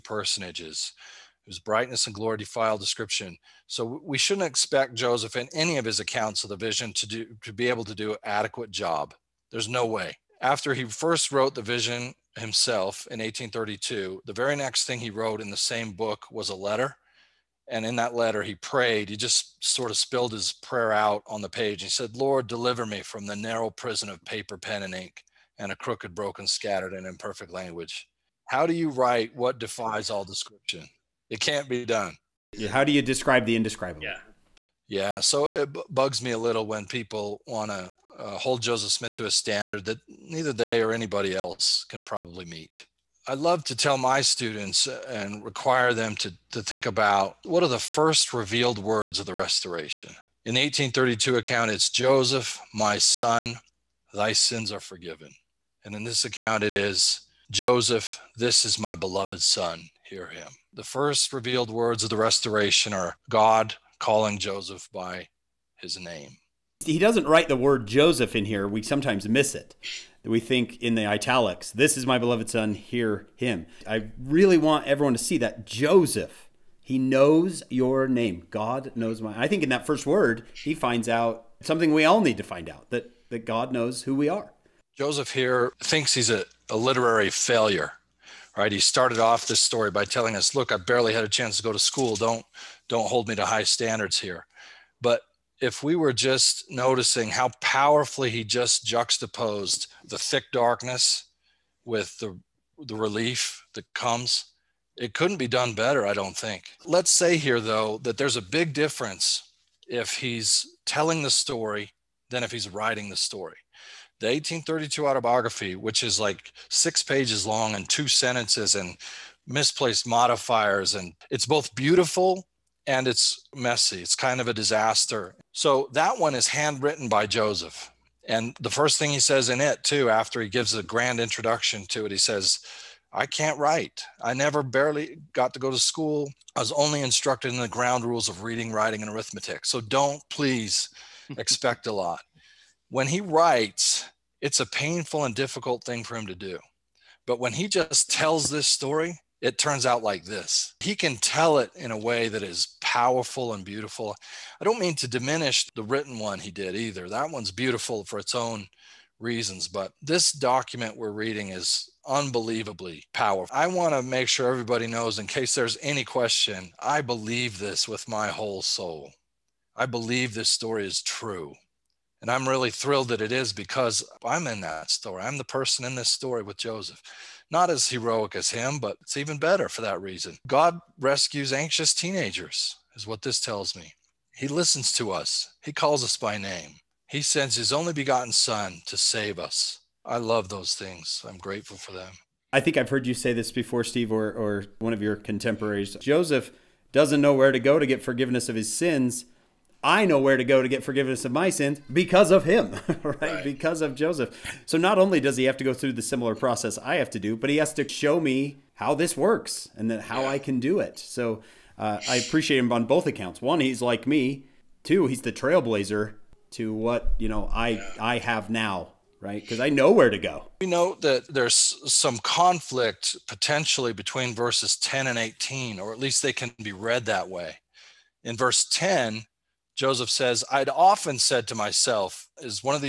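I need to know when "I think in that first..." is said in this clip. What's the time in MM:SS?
01:19.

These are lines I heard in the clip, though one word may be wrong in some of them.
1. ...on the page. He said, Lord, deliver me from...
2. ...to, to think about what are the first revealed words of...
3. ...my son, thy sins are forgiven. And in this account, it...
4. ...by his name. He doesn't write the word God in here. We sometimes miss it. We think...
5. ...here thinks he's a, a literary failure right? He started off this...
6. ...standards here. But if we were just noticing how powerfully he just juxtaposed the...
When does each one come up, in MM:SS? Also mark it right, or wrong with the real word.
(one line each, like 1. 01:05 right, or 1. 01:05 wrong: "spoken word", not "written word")
1. 00:21 right
2. 00:46 right
3. 00:52 right
4. 01:04 wrong: "Joseph", not "God"
5. 01:25 right
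6. 01:33 right.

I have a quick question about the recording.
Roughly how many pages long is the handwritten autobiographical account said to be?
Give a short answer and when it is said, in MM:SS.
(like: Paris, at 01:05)
6, at 01:56.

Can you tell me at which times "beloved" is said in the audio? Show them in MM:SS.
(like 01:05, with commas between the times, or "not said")
00:58, 01:12.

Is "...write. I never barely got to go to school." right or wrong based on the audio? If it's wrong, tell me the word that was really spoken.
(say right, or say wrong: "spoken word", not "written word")
right.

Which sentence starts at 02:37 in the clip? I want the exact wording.
That one's beautiful for its own reasons, but this document we're reading is unbelievably powerful.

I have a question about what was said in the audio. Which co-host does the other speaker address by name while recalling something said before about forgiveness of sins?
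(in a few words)
Steve.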